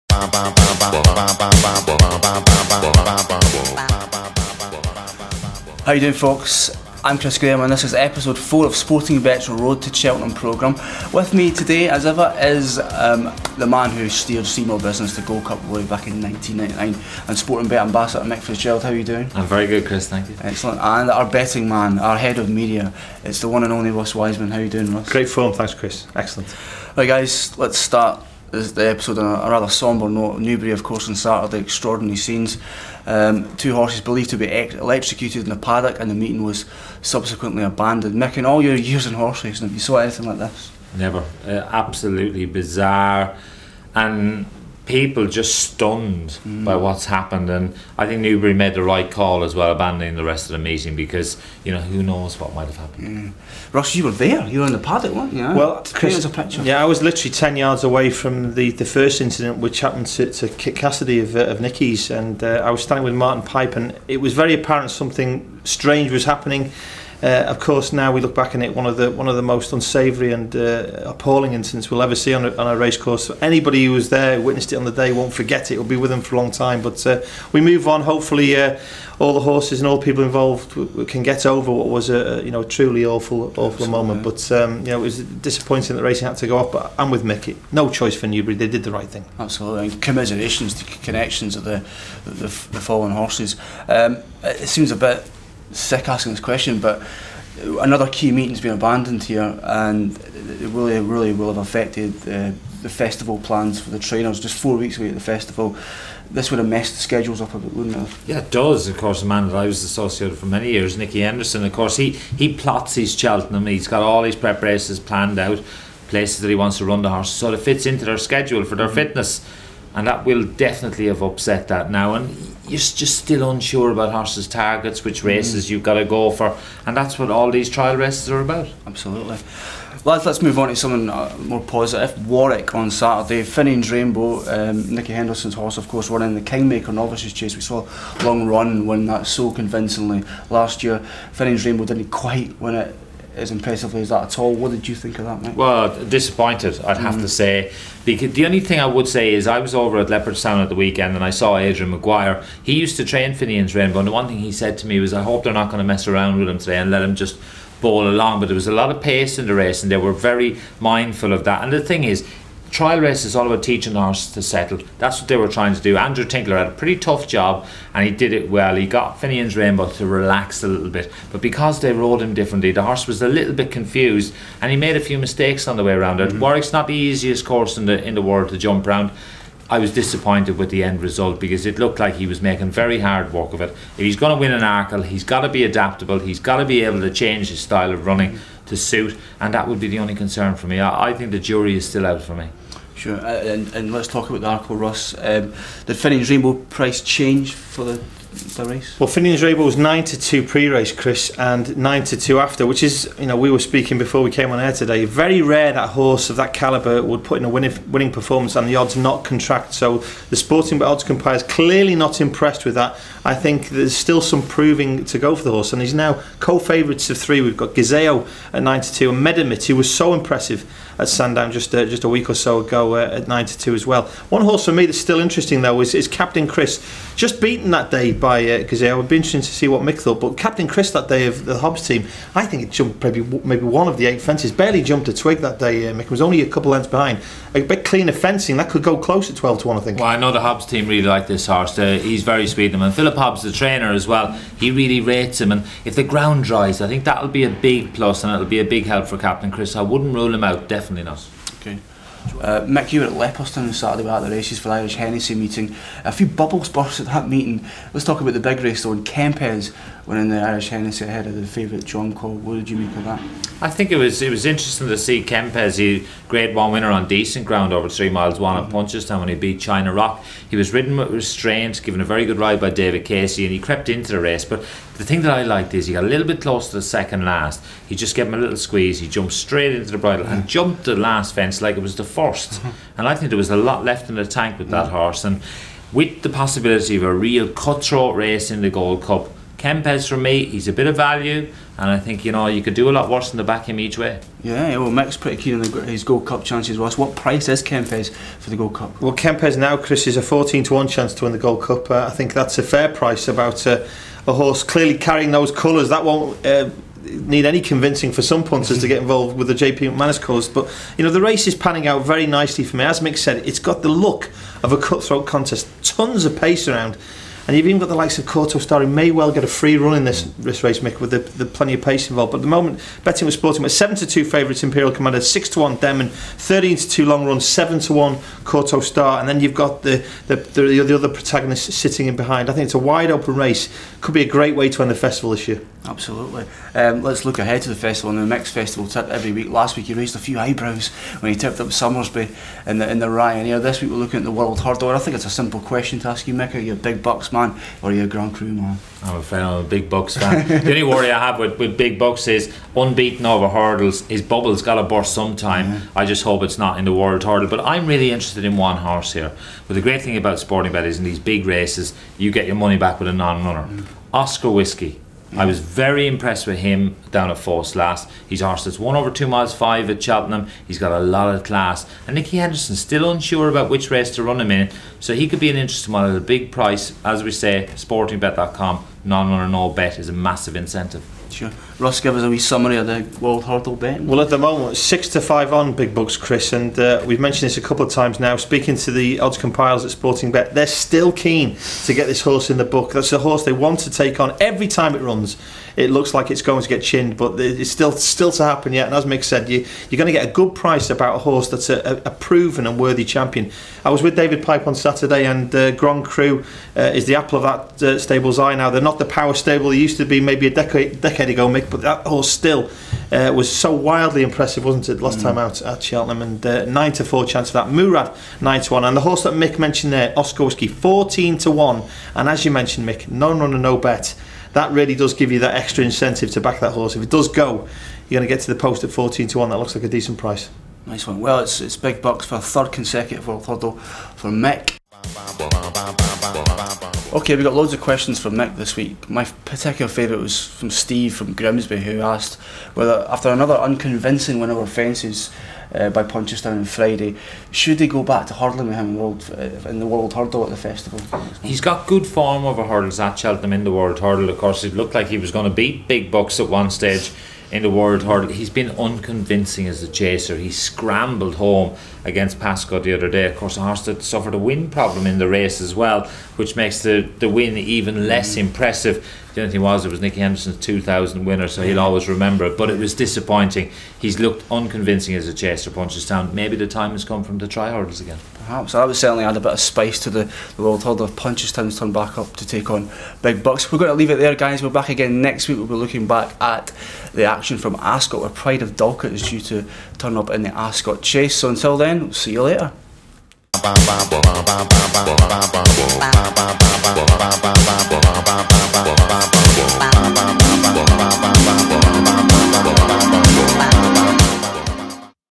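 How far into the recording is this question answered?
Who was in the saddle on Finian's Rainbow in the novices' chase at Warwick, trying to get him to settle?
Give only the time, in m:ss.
2:45.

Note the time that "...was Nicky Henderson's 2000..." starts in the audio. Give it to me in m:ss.
7:49.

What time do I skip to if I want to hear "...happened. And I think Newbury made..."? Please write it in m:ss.
0:47.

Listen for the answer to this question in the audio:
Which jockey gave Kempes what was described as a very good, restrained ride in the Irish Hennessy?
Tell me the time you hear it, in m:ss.
4:32.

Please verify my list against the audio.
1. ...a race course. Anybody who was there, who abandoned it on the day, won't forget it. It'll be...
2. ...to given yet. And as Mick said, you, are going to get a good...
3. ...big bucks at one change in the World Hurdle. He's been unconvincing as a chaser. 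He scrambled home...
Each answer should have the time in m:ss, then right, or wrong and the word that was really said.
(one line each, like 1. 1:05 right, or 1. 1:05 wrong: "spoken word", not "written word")
1. 1:12 wrong: "witnessed", not "abandoned"
2. 6:38 wrong: "happen", not "given"
3. 7:35 wrong: "stage", not "change".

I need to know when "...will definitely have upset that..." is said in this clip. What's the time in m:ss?
2:00.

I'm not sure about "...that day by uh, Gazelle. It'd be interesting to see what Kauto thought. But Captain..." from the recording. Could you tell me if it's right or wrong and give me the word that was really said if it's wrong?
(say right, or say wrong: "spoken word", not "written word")
wrong: "Mick", not "Kauto".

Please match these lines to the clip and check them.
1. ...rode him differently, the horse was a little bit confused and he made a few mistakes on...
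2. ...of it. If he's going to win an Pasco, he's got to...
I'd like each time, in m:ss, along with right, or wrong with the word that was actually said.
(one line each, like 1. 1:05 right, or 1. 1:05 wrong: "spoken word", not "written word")
1. 2:51 right
2. 3:03 wrong: "Arkle", not "Pasco".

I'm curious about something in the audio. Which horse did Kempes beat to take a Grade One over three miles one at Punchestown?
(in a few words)
China Rock.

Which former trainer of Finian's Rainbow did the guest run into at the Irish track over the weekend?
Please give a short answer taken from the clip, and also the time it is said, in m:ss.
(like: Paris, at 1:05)
Adrian Maguire, at 2:31.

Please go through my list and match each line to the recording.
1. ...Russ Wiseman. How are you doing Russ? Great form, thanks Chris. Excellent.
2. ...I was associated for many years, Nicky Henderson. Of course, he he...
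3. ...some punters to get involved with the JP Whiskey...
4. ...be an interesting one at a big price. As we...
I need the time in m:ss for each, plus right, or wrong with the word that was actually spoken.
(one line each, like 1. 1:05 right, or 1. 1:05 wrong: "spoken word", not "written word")
1. 0:23 right
2. 1:49 right
3. 5:08 wrong: "McManus", not "Whiskey"
4. 6:15 right.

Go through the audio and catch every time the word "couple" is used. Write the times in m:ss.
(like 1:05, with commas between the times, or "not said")
3:56, 6:27.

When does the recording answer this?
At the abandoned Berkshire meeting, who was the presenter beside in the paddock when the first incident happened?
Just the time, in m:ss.
1:03.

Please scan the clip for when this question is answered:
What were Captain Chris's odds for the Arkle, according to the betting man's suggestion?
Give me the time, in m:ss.
3:59.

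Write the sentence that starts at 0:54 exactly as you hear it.
You were in the paddock, weren't you?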